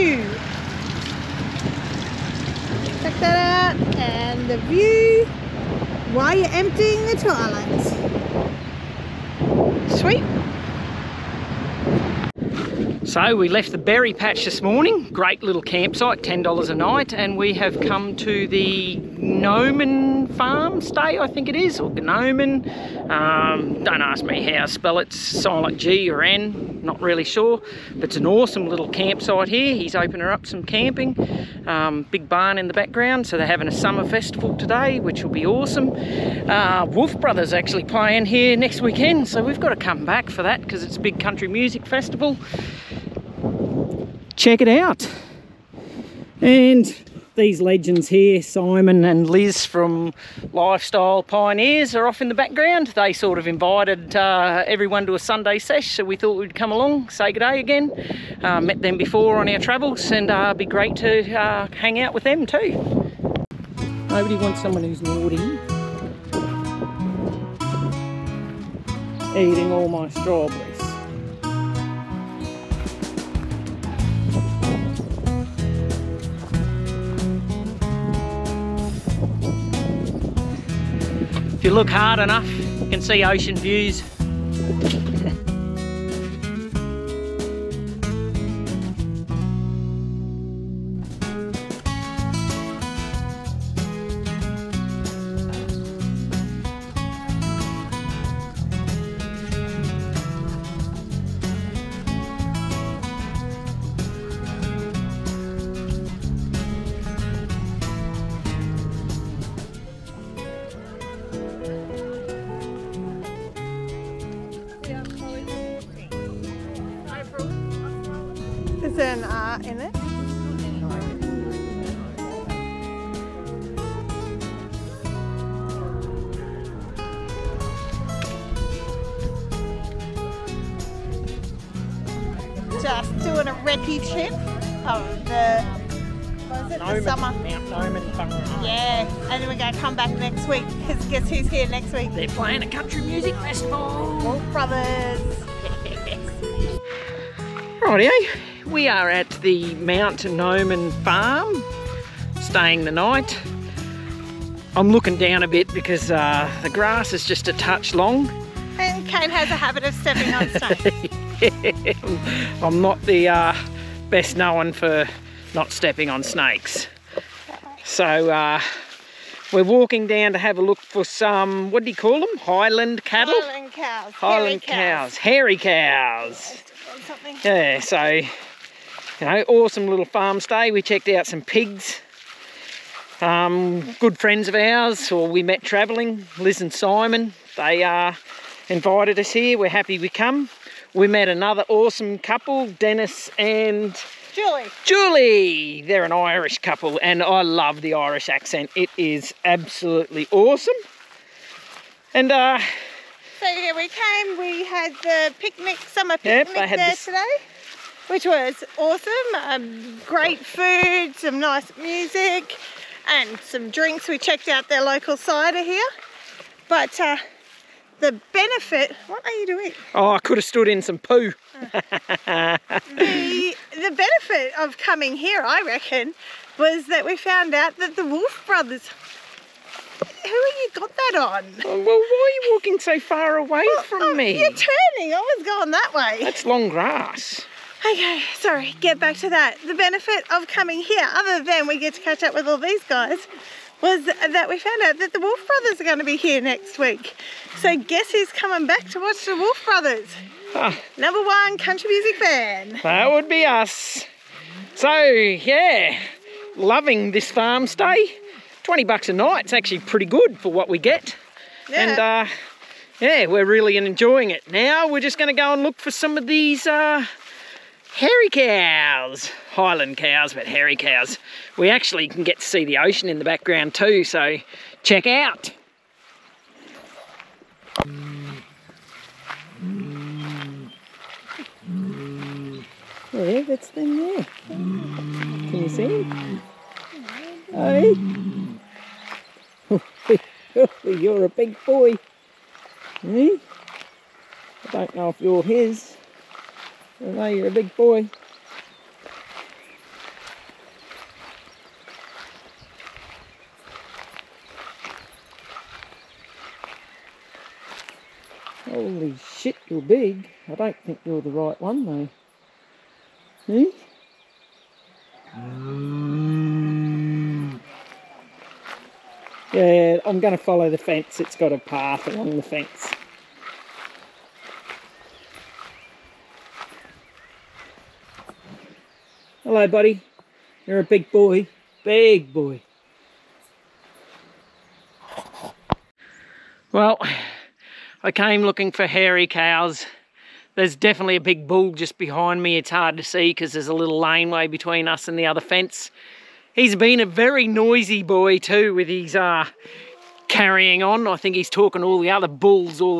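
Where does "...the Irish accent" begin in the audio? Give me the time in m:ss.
3:17.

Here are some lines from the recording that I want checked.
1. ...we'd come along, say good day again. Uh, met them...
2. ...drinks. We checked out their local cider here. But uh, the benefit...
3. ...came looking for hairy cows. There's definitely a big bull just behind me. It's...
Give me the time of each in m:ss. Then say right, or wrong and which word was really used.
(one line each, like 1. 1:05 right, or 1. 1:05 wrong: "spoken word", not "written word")
1. 0:56 right
2. 3:33 right
3. 5:38 right.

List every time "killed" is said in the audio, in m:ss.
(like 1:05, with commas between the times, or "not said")
not said.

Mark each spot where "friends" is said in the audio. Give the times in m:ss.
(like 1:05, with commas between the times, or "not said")
3:04.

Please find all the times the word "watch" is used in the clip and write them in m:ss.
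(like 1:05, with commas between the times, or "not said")
4:08.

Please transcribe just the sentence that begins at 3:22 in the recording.
And uh So yeah, we came, we had the picnic, summer picnic yep, there this.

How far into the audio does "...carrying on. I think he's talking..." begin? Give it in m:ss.
5:50.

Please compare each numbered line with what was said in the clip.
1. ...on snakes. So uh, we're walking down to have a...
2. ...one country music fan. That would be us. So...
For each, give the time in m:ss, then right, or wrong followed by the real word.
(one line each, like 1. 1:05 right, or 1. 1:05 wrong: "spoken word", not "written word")
1. 2:46 right
2. 4:11 right.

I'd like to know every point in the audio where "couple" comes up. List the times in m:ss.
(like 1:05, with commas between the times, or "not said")
3:12, 3:16.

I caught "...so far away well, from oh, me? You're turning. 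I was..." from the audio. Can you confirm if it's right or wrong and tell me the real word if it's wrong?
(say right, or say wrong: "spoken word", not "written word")
right.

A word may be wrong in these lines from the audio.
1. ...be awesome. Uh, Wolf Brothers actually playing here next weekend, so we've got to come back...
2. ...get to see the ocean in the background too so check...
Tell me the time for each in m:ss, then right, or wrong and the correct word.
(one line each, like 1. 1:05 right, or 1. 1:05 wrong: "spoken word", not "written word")
1. 0:35 right
2. 4:32 right.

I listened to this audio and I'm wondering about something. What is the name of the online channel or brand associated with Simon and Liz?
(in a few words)
Lifestyle Pioneers.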